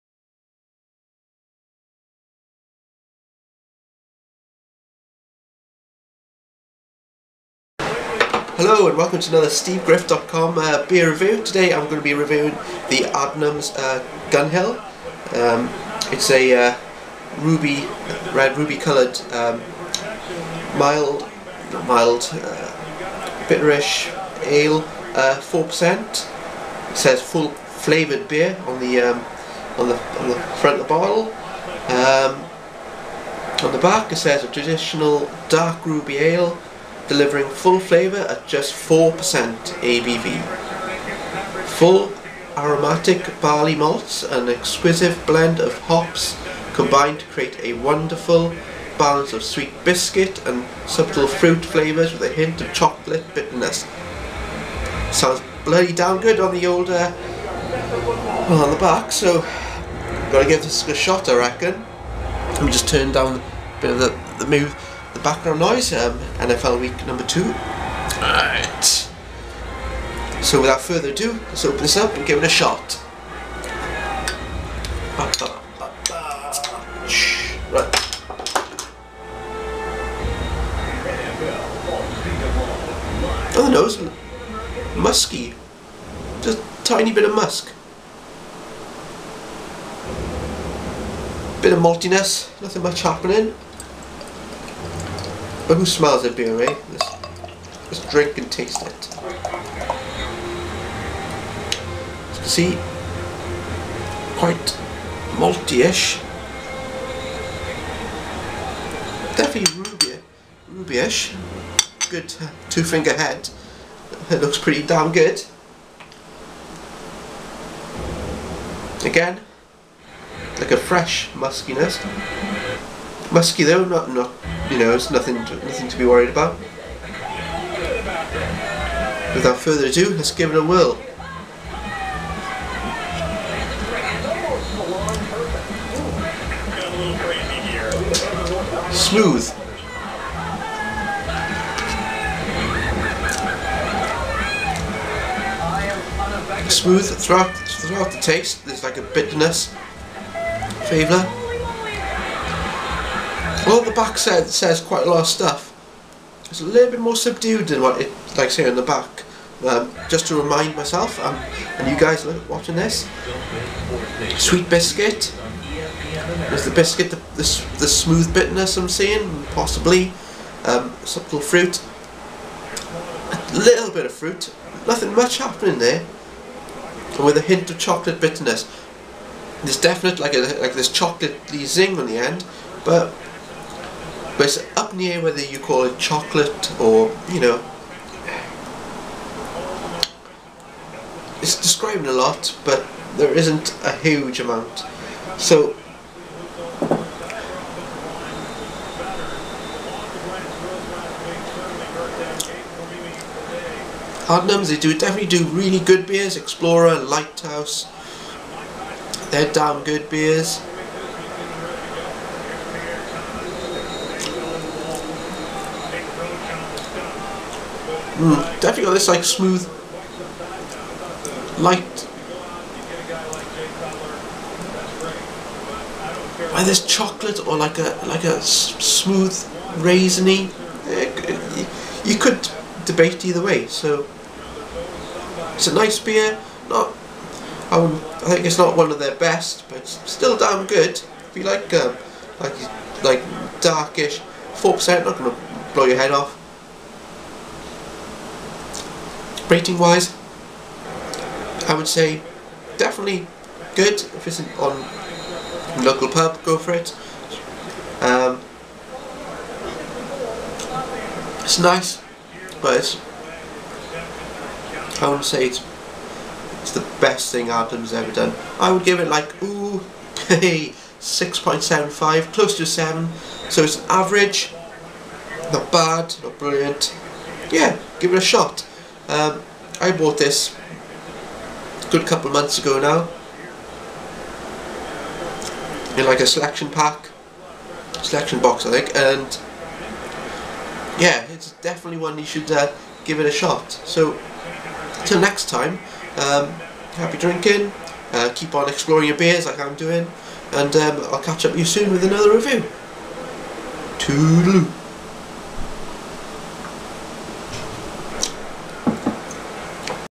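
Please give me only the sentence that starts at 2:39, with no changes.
Um, just to remind myself um, and you guys watching this, sweet biscuit.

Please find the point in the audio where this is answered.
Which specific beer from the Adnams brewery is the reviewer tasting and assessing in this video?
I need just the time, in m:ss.
0:14.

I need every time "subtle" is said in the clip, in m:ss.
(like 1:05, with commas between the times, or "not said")
0:50, 2:51.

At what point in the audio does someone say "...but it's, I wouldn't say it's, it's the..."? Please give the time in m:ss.
4:22.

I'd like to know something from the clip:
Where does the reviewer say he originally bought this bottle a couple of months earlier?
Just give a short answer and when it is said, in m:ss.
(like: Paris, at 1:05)
selection pack, at 4:46.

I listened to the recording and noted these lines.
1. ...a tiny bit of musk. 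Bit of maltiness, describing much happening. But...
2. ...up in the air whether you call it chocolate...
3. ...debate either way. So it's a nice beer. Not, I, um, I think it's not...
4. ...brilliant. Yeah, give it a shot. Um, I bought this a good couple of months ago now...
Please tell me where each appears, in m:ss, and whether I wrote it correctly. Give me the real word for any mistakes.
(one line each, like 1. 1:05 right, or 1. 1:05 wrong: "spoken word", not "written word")
1. 1:26 wrong: "nothing", not "describing"
2. 3:04 right
3. 3:52 right
4. 4:36 right.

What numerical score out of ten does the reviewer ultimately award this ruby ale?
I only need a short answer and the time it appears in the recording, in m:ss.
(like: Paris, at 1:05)
6.75, at 4:31.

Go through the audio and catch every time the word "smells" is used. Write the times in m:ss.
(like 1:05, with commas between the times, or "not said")
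1:35.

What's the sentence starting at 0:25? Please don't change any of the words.
Uh, it says full flavoured beer on the, um, on the on the front of the bottle.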